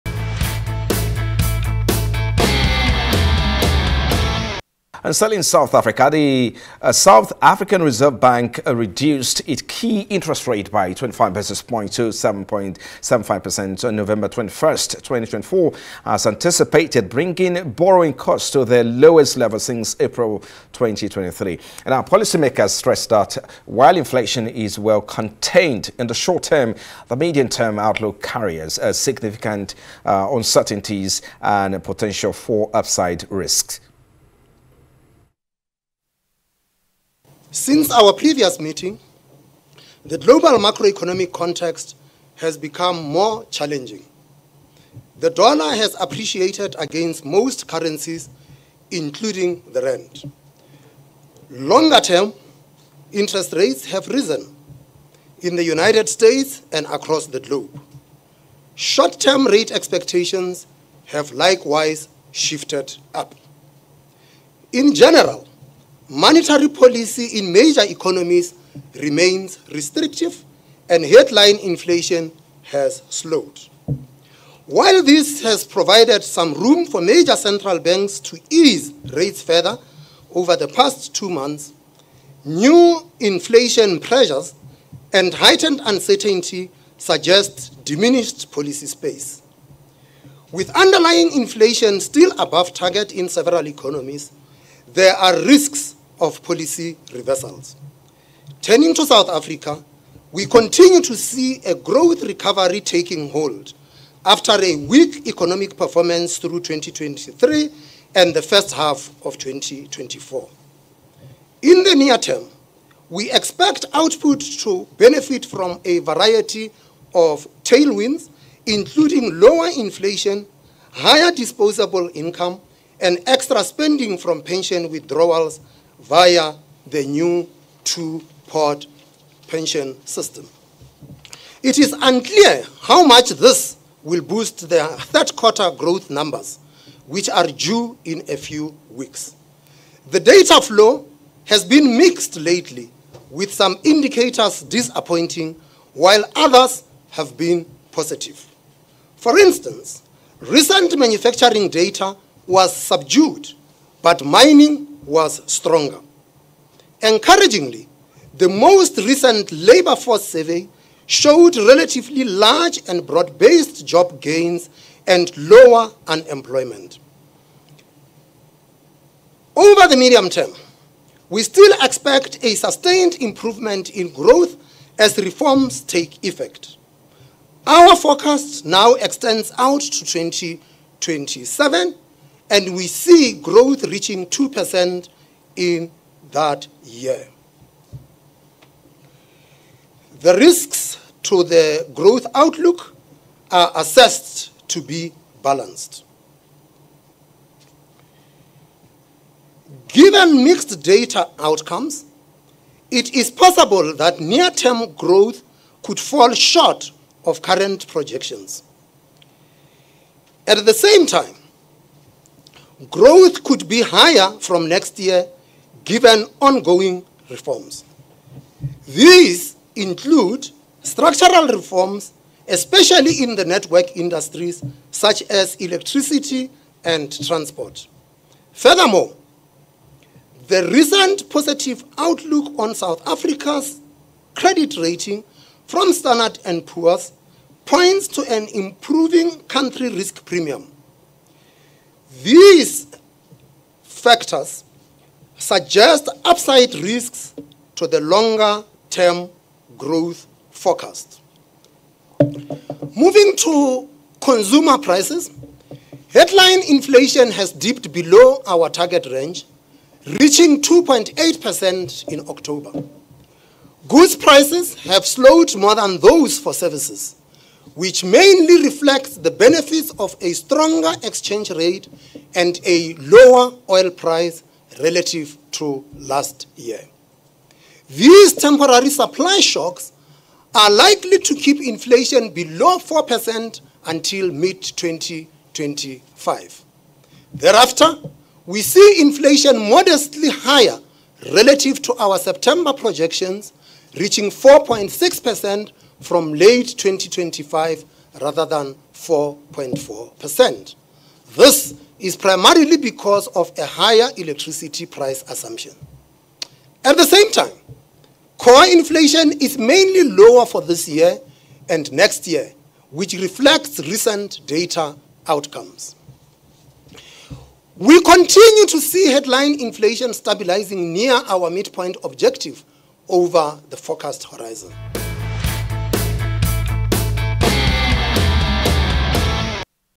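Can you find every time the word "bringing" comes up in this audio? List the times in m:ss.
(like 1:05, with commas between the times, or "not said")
0:17.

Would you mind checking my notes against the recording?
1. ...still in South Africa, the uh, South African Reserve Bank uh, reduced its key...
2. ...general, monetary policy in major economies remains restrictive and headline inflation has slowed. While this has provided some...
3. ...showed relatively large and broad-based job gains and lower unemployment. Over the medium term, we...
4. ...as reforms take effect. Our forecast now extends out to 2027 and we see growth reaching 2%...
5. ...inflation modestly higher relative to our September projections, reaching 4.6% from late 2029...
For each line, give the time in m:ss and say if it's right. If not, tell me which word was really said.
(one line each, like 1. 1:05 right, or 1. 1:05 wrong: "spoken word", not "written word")
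1. 0:05 right
2. 1:04 right
3. 2:41 right
4. 2:54 right
5. 4:49 wrong: "2025", not "2029".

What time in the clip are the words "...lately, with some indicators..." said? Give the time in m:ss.
2:22.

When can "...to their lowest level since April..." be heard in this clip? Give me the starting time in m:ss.
0:18.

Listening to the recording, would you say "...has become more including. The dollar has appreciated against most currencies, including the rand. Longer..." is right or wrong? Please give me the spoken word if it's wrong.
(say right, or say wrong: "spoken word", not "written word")
wrong: "challenging", not "including".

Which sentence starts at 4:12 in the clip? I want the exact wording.
Moving to consumer prices, headline inflation has dipped below our target range, reaching 2.8% in October.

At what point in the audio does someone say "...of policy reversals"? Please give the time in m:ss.
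1:36.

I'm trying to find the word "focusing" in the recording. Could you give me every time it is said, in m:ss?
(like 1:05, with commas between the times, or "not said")
not said.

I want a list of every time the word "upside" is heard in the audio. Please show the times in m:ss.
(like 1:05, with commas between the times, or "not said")
0:32, 4:06.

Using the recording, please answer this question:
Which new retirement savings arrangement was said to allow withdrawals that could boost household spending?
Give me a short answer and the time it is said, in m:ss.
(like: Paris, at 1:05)
2 pot pension system, at 2:07.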